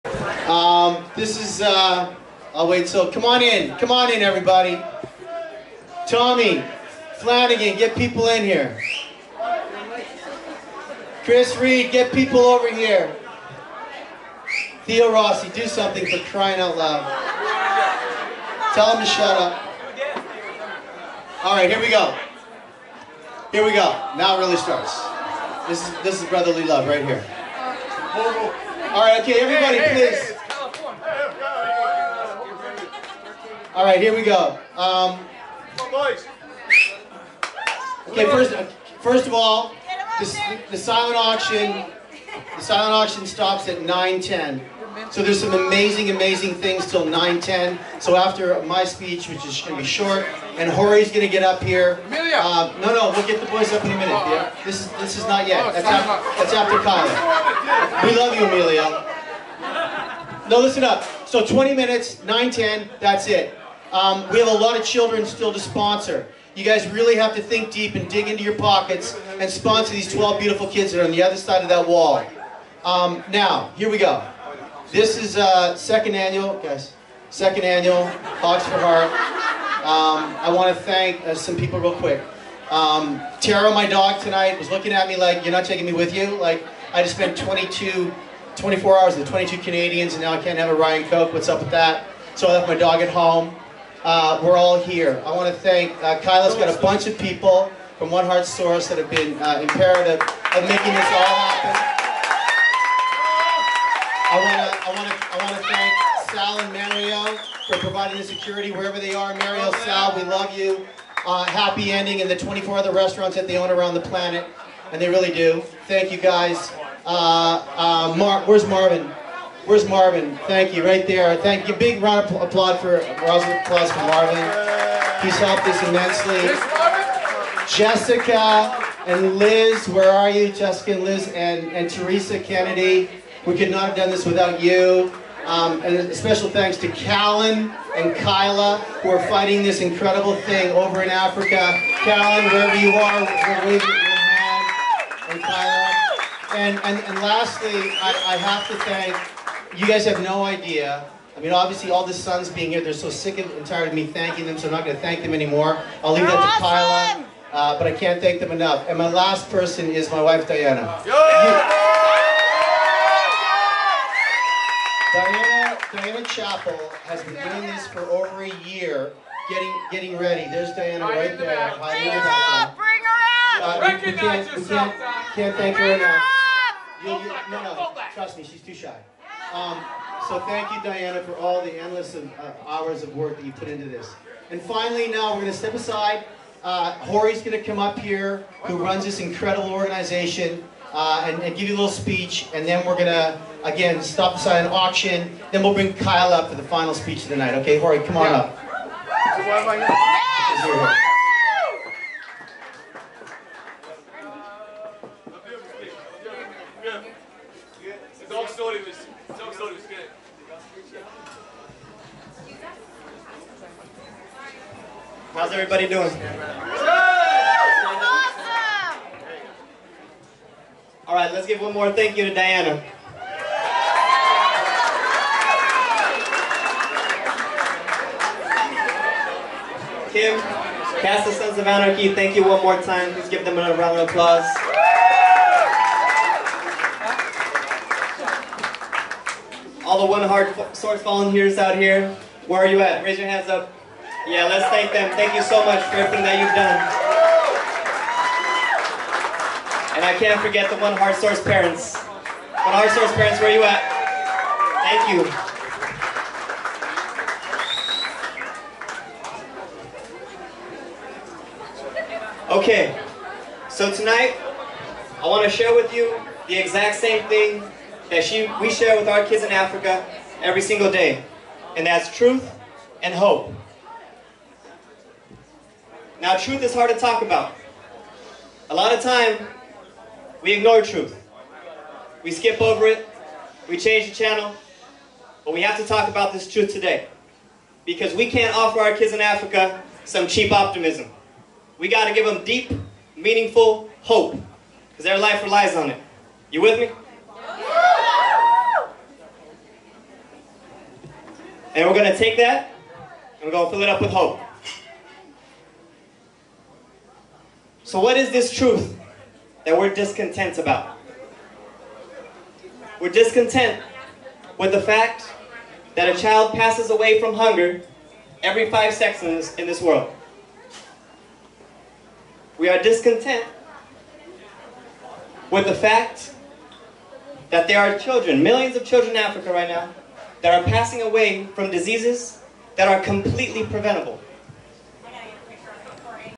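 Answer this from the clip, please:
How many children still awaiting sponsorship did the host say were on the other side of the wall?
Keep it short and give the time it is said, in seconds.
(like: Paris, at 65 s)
12, at 70 s.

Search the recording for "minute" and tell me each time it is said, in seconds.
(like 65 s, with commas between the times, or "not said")
53 s, 61 s.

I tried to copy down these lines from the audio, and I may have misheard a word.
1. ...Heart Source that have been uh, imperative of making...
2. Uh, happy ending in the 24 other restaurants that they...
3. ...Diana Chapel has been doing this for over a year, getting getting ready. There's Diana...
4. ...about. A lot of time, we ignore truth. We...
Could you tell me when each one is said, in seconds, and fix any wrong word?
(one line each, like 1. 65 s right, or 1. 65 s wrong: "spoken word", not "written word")
1. 98 s right
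2. 111 s right
3. 165 s right
4. 277 s right.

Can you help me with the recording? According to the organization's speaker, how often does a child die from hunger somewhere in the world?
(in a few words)
every 5 seconds.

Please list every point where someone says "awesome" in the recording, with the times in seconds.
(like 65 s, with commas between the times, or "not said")
156 s, 216 s.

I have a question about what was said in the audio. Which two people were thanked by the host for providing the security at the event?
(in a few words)
Sal and Mario.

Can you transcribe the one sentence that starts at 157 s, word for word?
Kyla, uh, but I can't thank them enough.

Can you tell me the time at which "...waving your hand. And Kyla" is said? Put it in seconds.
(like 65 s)
143 s.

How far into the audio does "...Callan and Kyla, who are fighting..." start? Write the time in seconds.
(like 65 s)
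136 s.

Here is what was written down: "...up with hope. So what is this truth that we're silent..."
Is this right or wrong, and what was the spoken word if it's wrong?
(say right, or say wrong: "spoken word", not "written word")
wrong: "discontent", not "silent".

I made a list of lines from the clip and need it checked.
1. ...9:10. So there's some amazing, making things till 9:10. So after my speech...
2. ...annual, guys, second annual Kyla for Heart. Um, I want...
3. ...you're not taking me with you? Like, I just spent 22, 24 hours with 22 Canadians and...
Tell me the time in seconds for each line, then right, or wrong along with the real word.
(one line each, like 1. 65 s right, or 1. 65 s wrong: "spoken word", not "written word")
1. 43 s wrong: "amazing", not "making"
2. 76 s wrong: "Hogs", not "Kyla"
3. 85 s right.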